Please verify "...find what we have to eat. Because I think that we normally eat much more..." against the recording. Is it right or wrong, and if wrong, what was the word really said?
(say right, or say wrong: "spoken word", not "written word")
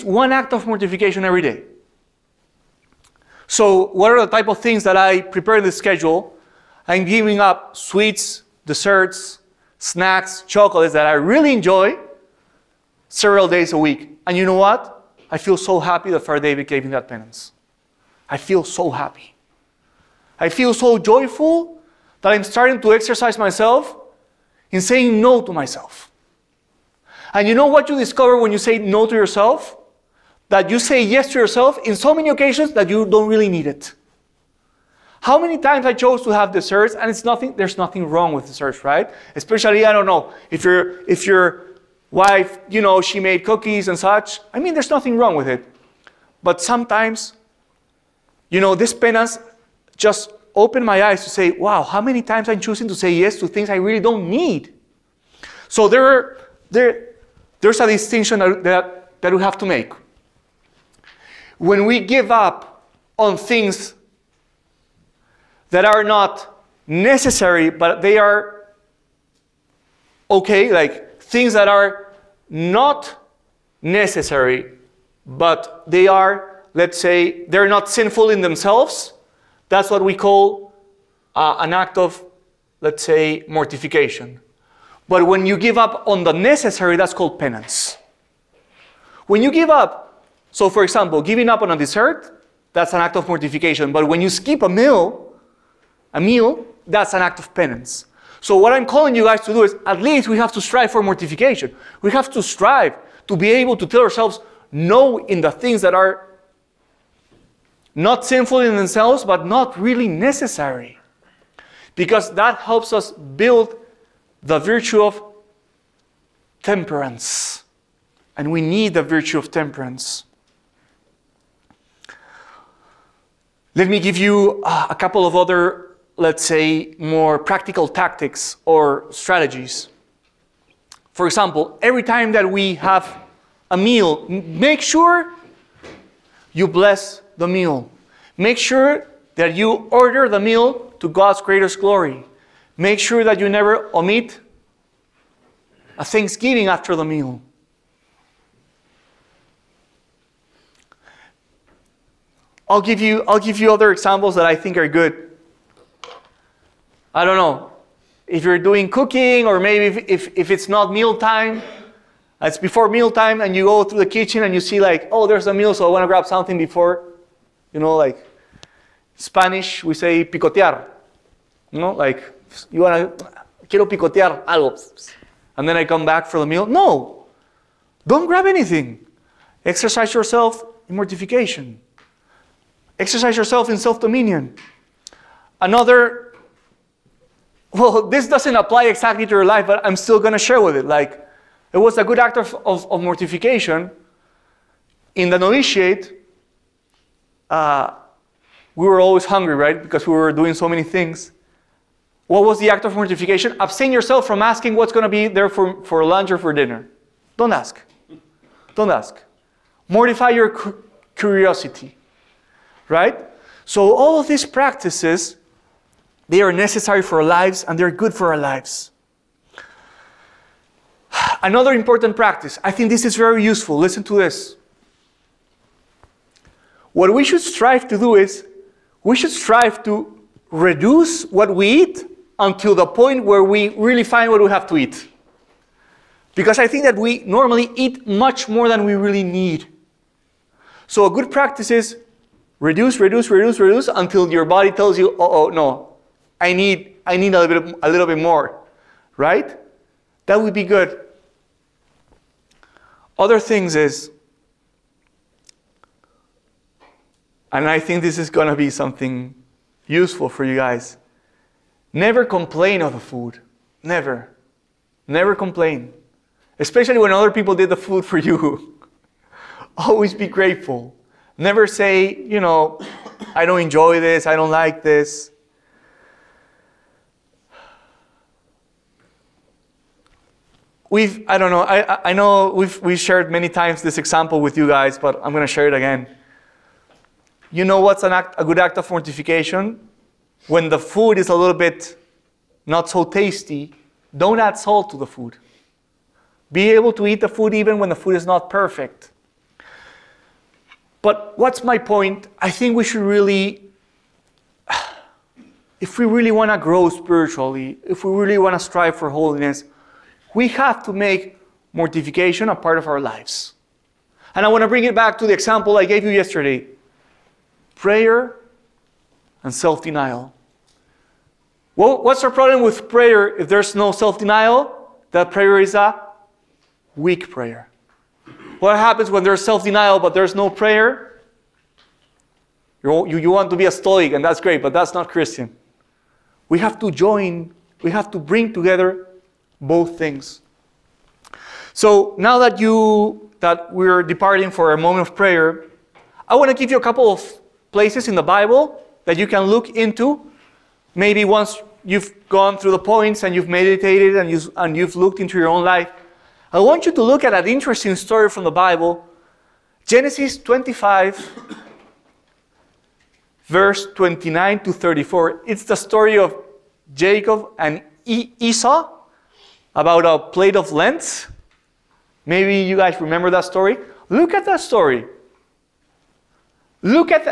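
right.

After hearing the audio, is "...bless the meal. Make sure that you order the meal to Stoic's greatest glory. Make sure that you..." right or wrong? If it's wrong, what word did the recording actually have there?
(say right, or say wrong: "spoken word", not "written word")
wrong: "God", not "Stoic".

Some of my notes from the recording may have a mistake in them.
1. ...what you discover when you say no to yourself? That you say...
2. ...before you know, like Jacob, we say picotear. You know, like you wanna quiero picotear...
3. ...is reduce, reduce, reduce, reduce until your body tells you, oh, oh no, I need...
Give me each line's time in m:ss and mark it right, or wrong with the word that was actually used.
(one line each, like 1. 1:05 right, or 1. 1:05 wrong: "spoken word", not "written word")
1. 0:27 right
2. 2:46 wrong: "Spanish", not "Jacob"
3. 4:01 right.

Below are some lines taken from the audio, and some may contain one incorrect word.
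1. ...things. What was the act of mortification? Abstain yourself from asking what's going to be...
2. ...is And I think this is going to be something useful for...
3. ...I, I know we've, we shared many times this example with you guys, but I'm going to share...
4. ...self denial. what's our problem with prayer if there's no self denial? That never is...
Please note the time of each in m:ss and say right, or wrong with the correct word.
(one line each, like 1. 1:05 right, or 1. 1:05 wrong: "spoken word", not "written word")
1. 3:20 right
2. 4:13 right
3. 4:41 right
4. 5:19 wrong: "prayer", not "never".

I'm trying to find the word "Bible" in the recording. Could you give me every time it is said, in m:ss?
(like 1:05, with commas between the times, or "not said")
5:48, 5:58.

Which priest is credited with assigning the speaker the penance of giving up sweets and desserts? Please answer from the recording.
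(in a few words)
Father David.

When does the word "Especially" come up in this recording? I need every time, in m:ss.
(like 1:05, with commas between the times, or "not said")
0:39, 4:26.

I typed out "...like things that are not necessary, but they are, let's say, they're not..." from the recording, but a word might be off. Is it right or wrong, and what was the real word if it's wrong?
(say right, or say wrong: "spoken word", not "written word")
right.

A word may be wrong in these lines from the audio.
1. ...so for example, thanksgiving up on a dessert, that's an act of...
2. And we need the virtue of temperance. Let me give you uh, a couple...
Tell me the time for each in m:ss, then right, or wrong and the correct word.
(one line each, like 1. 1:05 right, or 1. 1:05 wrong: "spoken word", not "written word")
1. 1:30 wrong: "giving", not "thanksgiving"
2. 1:58 right.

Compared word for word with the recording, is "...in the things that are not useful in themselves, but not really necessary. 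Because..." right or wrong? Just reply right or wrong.
wrong.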